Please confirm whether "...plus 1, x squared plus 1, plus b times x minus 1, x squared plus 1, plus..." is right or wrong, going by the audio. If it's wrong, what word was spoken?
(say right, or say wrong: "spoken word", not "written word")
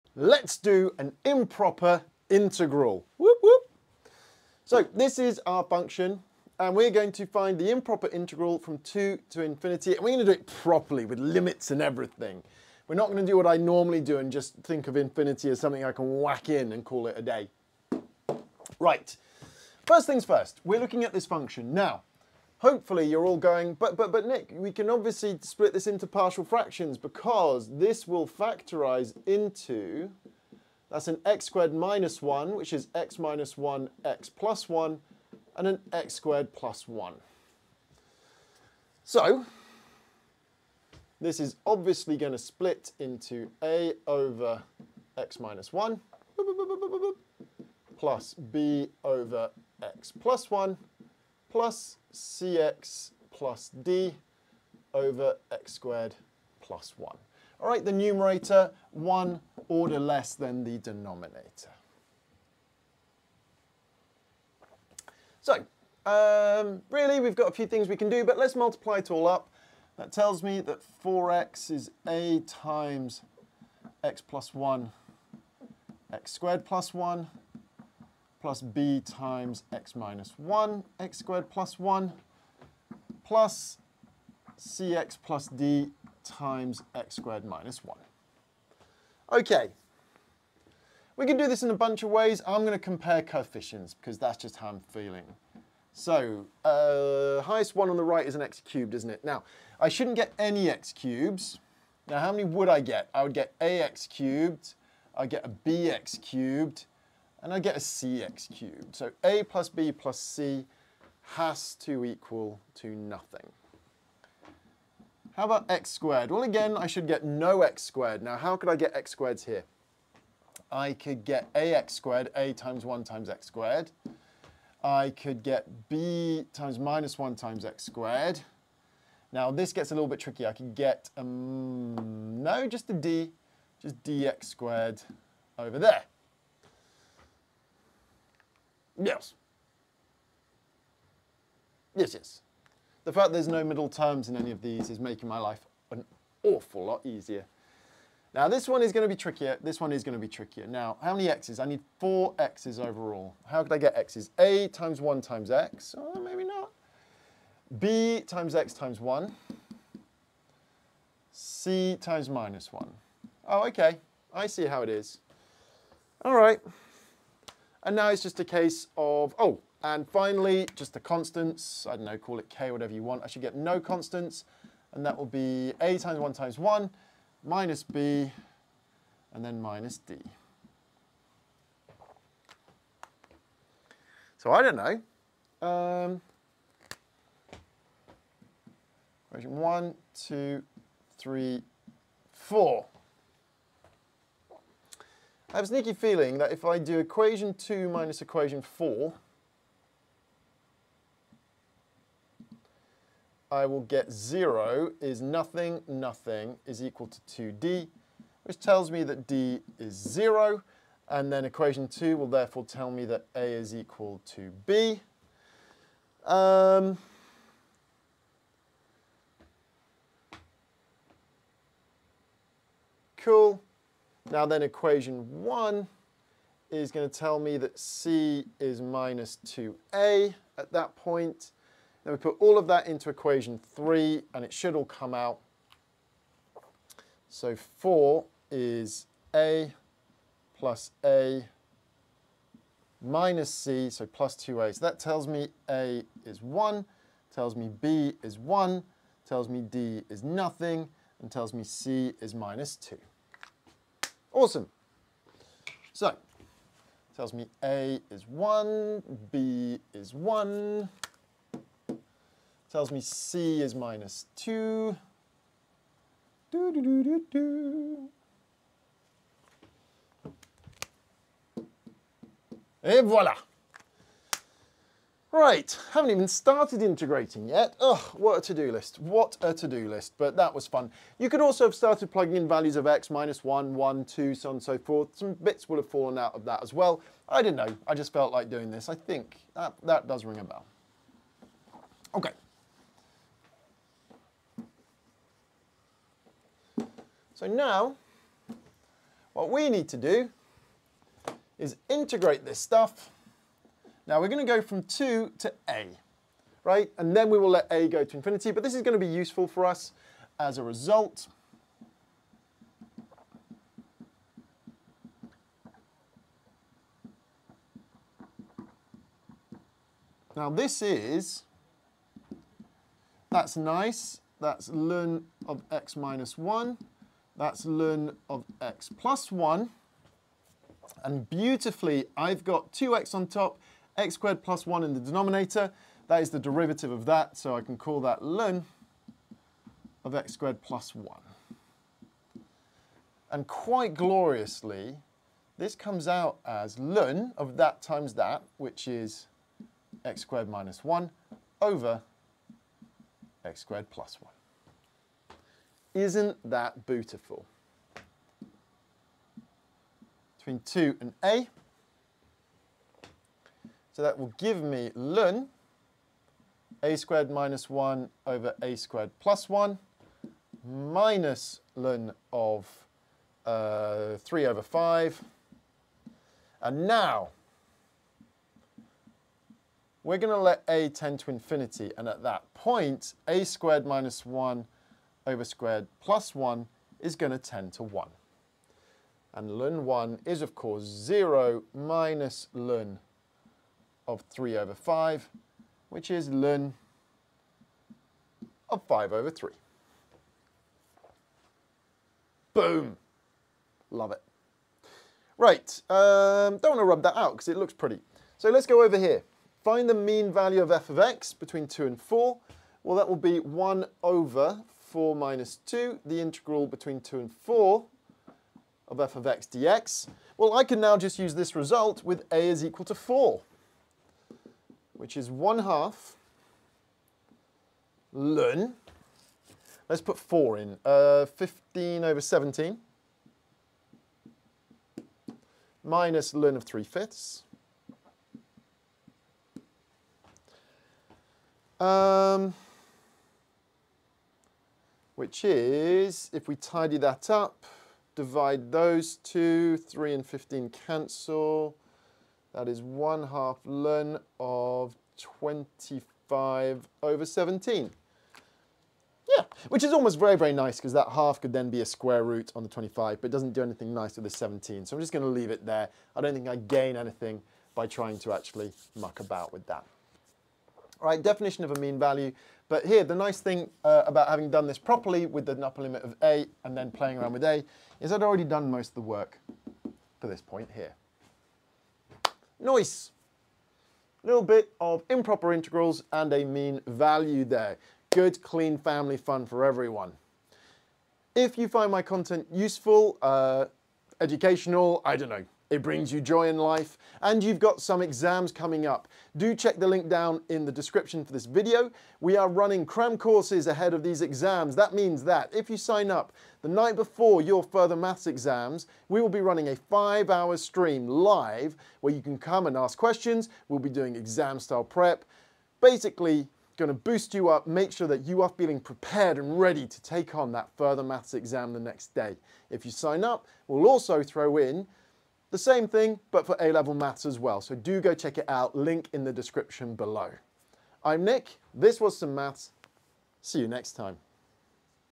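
right.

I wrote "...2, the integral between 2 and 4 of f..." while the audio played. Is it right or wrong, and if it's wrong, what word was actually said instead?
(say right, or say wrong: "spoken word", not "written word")
right.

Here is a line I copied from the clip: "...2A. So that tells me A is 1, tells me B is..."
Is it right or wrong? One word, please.
right.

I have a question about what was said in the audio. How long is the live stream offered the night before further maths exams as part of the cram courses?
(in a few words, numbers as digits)
5 hours.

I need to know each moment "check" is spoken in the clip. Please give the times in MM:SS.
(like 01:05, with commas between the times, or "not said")
08:19, 08:48.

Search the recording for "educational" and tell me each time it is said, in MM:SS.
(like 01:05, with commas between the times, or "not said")
08:14.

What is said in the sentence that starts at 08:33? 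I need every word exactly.
We'll be doing exam style prep.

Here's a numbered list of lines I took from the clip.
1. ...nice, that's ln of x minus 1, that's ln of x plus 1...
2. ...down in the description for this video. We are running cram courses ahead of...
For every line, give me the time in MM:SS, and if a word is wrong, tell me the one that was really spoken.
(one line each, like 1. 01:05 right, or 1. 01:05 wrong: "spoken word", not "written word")
1. 05:23 right
2. 08:20 right.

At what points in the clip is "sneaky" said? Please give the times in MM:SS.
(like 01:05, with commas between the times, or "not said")
03:15.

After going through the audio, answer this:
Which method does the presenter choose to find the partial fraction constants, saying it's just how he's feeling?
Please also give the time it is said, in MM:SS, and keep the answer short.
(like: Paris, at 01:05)
compare coefficients, at 01:32.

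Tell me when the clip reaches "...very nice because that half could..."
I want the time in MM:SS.
07:40.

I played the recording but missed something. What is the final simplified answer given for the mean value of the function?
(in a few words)
1/2 ln(25/17).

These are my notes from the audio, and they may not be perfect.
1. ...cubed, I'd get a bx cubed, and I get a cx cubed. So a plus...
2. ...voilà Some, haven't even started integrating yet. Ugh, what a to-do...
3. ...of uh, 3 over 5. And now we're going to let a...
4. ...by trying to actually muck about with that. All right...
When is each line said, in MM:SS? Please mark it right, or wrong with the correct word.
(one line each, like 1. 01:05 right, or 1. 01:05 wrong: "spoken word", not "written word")
1. 01:44 right
2. 04:33 wrong: "Right", not "Some"
3. 06:12 right
4. 07:47 right.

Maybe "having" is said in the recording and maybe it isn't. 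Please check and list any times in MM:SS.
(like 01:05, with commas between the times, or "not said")
07:54.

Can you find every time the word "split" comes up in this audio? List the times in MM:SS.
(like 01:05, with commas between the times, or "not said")
00:25, 00:42.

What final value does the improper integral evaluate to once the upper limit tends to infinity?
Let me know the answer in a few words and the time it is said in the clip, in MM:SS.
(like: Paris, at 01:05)
ln(5/3), at 06:36.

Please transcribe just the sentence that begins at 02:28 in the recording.
Now this one is going to be trickier, this one is going to be trickier.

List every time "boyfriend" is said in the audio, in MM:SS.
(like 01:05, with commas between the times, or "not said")
not said.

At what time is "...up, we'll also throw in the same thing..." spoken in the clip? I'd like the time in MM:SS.
08:43.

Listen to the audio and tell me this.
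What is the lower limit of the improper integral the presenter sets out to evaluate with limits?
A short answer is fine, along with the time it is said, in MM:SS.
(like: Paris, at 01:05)
2, at 00:08.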